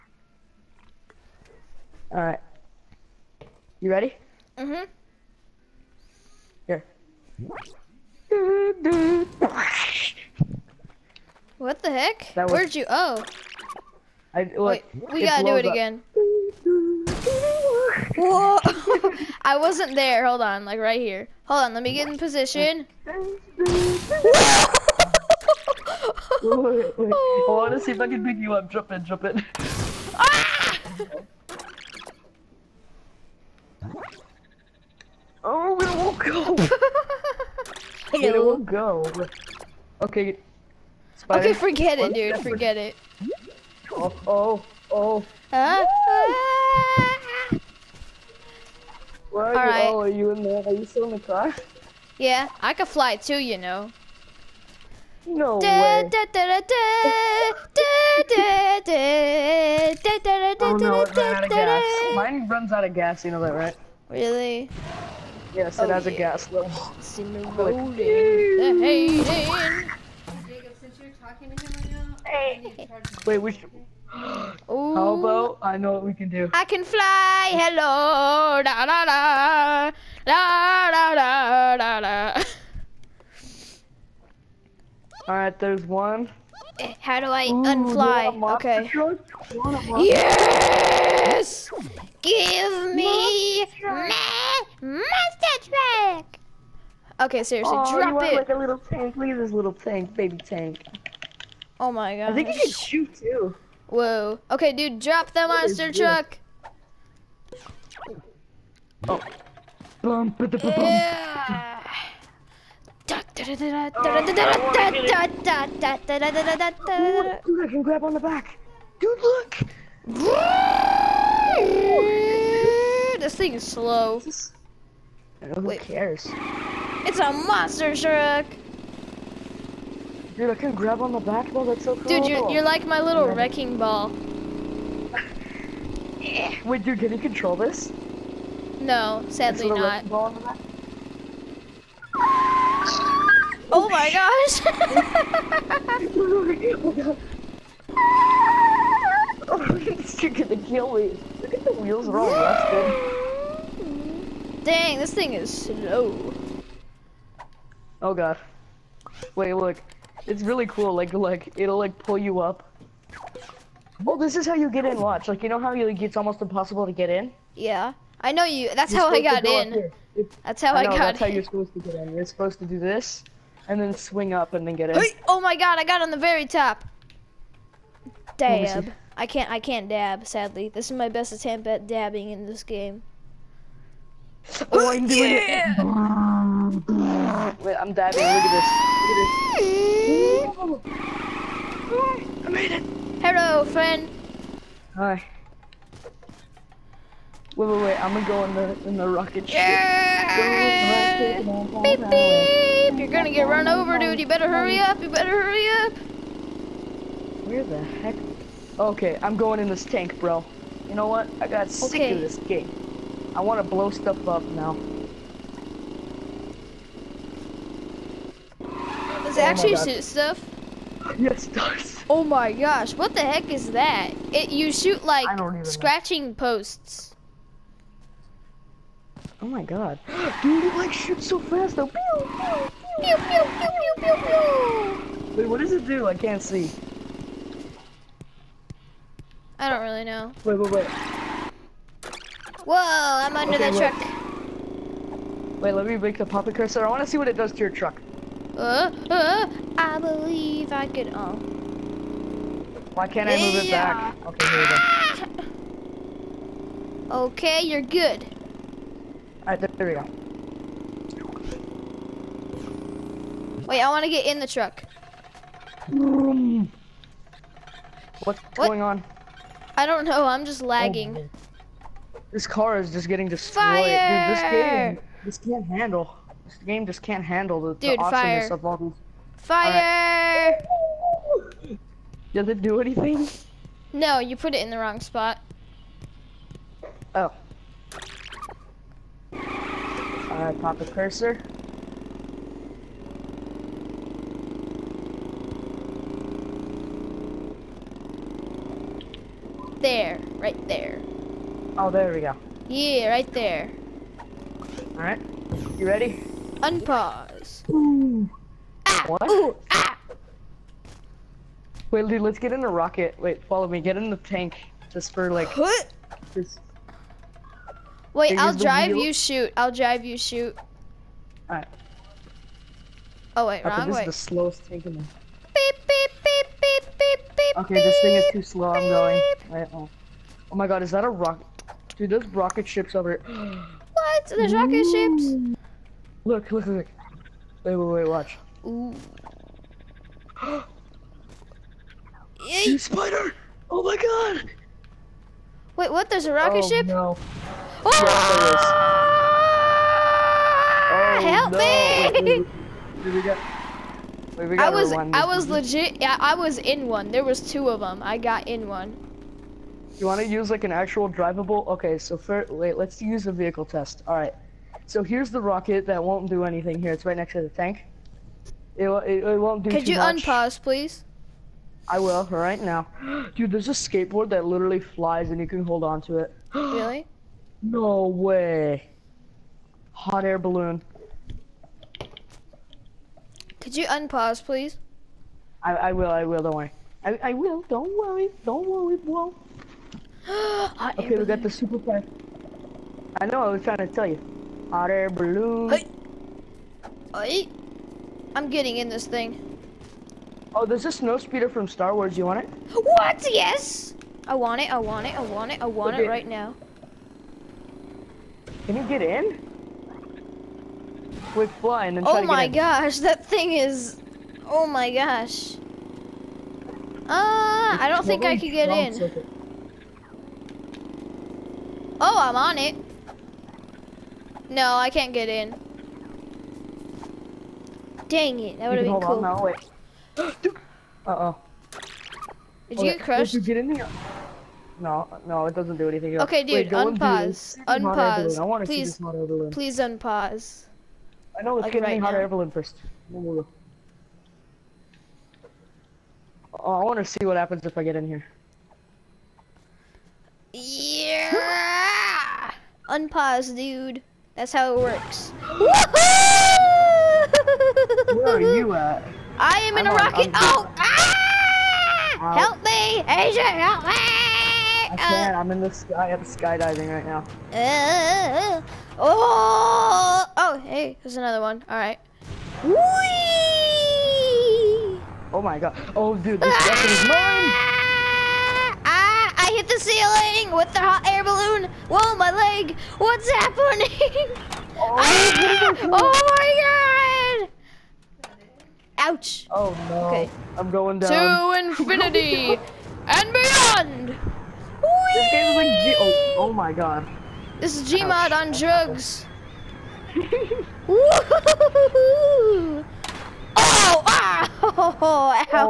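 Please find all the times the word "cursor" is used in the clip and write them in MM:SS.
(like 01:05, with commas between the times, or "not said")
04:06, 04:50.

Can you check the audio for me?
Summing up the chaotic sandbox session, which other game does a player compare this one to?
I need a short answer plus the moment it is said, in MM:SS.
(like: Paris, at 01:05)
Gmod, at 08:17.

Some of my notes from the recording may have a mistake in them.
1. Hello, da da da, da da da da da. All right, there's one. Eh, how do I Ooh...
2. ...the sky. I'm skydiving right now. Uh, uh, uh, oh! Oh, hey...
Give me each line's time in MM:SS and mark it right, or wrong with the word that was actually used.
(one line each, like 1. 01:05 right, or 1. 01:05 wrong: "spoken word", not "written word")
1. 01:17 right
2. 07:45 right.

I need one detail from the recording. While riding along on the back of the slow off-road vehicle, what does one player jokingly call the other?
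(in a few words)
wrecking ball.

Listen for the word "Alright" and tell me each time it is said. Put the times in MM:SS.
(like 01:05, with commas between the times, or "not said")
00:02, 04:19, 05:04, 05:21.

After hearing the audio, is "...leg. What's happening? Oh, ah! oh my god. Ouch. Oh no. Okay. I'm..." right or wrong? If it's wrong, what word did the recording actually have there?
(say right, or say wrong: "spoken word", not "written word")
right.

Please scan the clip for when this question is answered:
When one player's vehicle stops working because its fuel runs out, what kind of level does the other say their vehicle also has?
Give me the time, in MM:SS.
01:06.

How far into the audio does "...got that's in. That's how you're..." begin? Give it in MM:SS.
02:50.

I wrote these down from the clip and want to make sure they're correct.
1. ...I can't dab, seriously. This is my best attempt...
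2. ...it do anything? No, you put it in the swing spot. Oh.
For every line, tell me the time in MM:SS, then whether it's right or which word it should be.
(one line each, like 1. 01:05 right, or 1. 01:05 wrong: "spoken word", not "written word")
1. 02:59 wrong: "sadly", not "seriously"
2. 04:42 wrong: "wrong", not "swing".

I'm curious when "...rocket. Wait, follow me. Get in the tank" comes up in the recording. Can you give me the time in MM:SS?
05:12.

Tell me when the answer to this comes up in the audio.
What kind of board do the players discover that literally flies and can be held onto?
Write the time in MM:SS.
06:13.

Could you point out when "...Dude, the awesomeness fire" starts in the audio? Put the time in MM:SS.
04:37.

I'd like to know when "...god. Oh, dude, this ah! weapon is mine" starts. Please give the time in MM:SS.
07:55.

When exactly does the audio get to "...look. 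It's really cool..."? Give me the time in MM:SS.
02:39.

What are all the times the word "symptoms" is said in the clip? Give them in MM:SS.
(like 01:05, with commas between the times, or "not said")
not said.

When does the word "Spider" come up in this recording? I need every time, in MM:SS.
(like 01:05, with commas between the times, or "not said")
00:41, 05:42.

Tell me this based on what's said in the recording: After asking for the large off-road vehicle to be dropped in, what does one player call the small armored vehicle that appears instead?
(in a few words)
baby tank.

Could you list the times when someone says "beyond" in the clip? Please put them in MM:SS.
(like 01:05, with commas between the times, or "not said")
08:13.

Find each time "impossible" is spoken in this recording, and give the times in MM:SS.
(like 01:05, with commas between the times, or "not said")
02:46.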